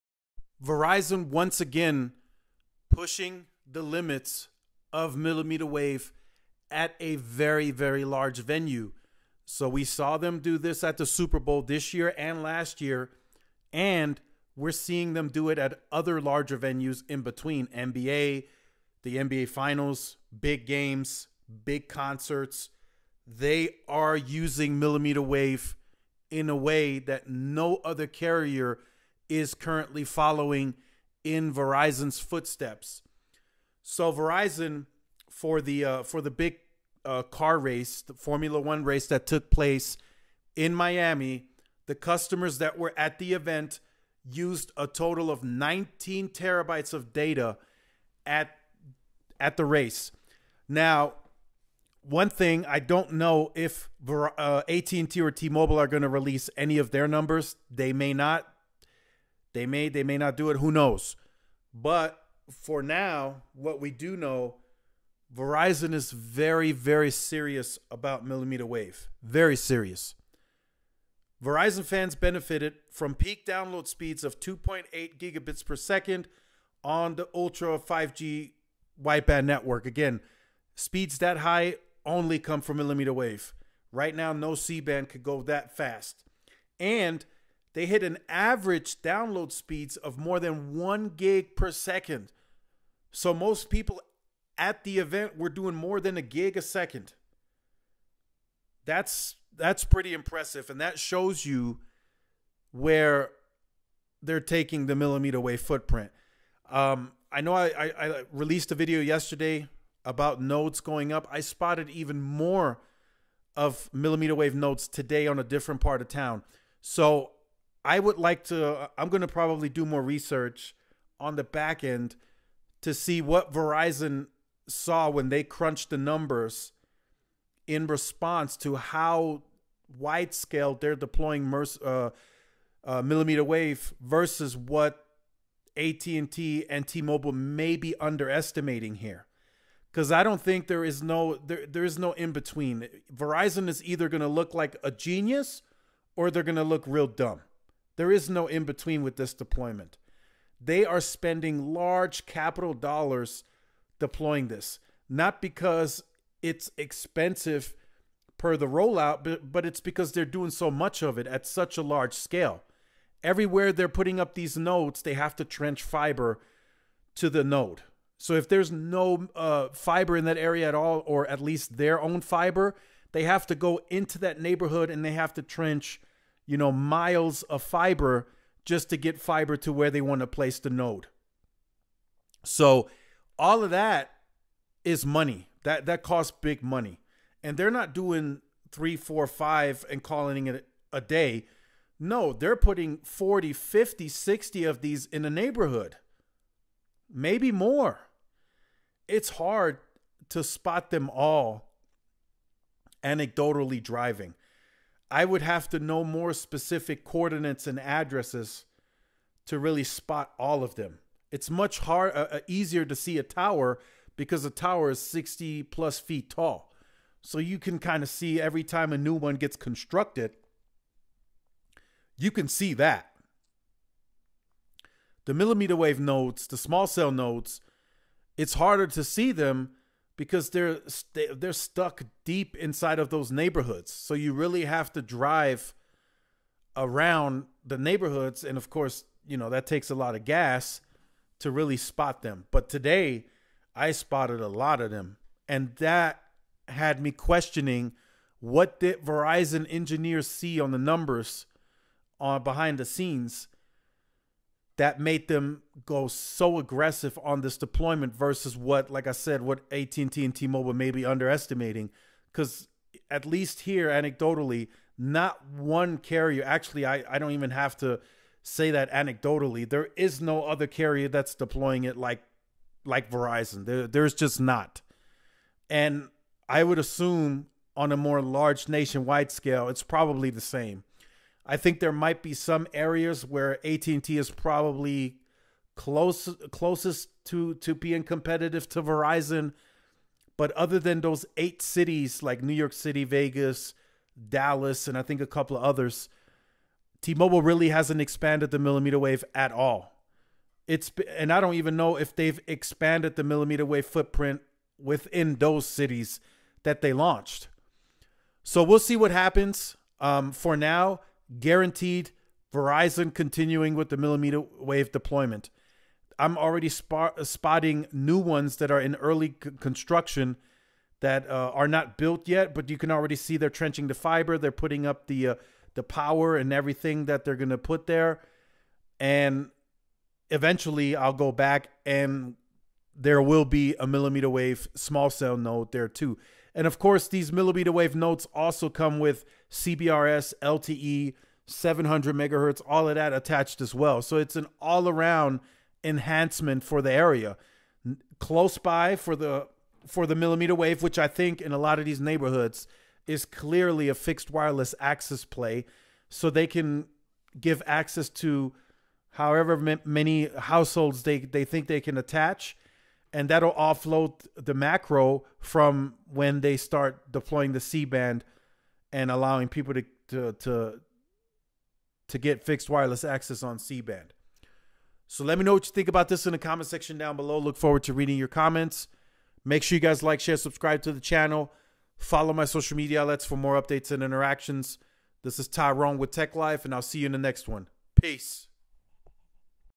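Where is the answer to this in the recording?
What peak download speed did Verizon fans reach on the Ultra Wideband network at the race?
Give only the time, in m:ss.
1:14.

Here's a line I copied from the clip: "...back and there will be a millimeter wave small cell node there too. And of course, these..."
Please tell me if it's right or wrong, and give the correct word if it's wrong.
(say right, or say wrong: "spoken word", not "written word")
right.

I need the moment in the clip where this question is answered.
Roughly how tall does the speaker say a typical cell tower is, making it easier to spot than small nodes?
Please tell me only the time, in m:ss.
3:34.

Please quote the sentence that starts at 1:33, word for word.
So most people at the event were doing more than a gig a second.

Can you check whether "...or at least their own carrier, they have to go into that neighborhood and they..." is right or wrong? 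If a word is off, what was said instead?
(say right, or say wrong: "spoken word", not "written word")
wrong: "fiber", not "carrier".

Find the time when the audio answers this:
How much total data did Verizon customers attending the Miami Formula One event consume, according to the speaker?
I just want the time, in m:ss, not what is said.
0:45.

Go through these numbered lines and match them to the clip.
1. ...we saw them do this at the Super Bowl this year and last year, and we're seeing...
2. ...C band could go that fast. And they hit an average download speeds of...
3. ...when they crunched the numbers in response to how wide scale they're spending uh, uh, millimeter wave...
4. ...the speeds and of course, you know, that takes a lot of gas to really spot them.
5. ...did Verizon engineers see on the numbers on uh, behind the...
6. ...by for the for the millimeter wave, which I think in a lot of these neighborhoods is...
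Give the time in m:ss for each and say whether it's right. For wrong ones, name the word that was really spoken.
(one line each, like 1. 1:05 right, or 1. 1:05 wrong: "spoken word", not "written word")
1. 0:09 right
2. 1:24 right
3. 2:05 wrong: "deploying", not "spending"
4. 3:57 wrong: "neighborhoods", not "speeds"
5. 4:08 right
6. 5:48 right.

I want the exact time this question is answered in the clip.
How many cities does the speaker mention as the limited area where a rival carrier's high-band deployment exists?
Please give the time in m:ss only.
4:51.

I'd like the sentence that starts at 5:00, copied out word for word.
It's and I don't even know if they've expanded the millimeter wave footprint within those cities that they launched.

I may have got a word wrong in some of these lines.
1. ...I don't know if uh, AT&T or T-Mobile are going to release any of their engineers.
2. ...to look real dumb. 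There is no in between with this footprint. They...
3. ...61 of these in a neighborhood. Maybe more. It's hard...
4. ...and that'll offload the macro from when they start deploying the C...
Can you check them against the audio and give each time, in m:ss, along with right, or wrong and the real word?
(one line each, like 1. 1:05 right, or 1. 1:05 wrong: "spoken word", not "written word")
1. 0:52 wrong: "numbers", not "engineers"
2. 2:26 wrong: "deployment", not "footprint"
3. 3:14 wrong: "60", not "61"
4. 6:03 right.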